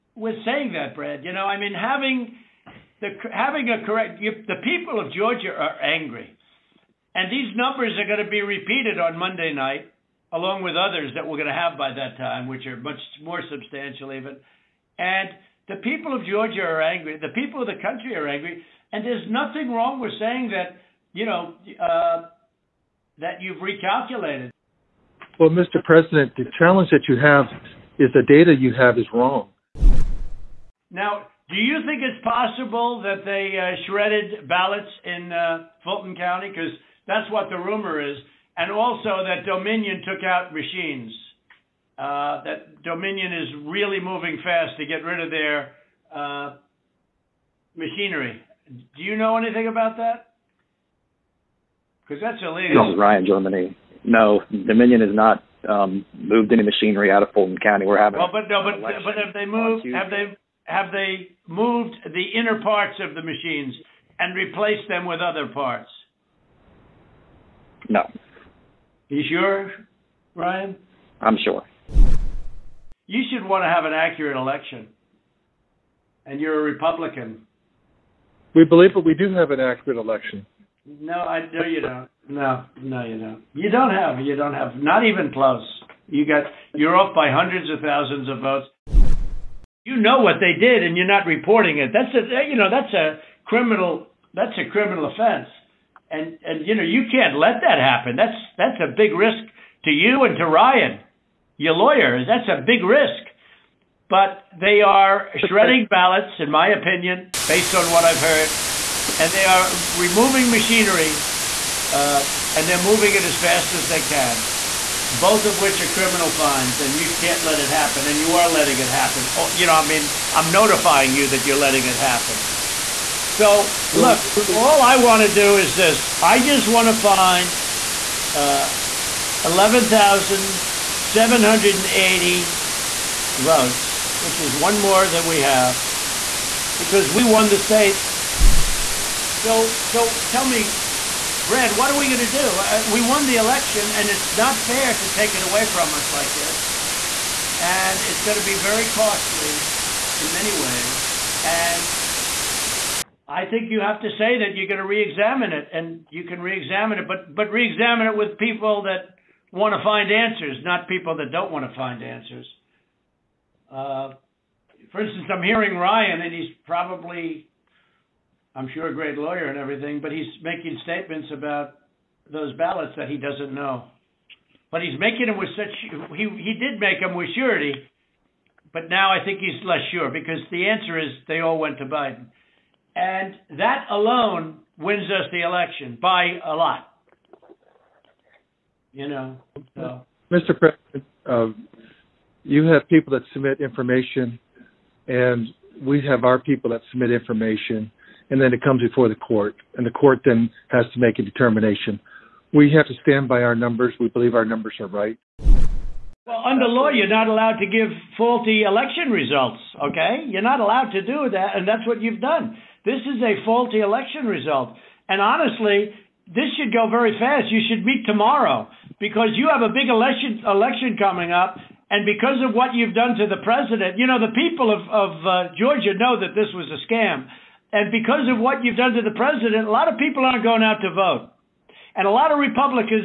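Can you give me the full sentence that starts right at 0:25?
President, the challenge that you have is the data you have is wrong.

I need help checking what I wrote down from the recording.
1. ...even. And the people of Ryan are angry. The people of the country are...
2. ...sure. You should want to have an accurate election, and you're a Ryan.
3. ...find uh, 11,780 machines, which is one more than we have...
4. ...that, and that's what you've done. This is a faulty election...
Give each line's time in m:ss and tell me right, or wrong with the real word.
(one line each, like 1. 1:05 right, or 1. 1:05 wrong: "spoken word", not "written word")
1. 0:14 wrong: "Georgia", not "Ryan"
2. 1:11 wrong: "Republican", not "Ryan"
3. 2:07 wrong: "votes", not "machines"
4. 3:31 right.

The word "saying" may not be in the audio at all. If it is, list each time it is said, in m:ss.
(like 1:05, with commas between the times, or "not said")
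0:00, 0:20.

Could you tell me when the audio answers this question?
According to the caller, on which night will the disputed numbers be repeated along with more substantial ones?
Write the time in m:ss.
0:09.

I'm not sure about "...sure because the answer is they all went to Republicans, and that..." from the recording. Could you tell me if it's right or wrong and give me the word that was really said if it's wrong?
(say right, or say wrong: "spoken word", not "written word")
wrong: "Biden", not "Republicans".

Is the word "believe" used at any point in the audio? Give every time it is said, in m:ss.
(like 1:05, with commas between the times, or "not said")
1:18, 3:24.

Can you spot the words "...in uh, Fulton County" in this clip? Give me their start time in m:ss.
0:35.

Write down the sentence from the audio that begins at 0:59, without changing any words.
Have they have they moved the inner parts of the machines and replaced them with other parts?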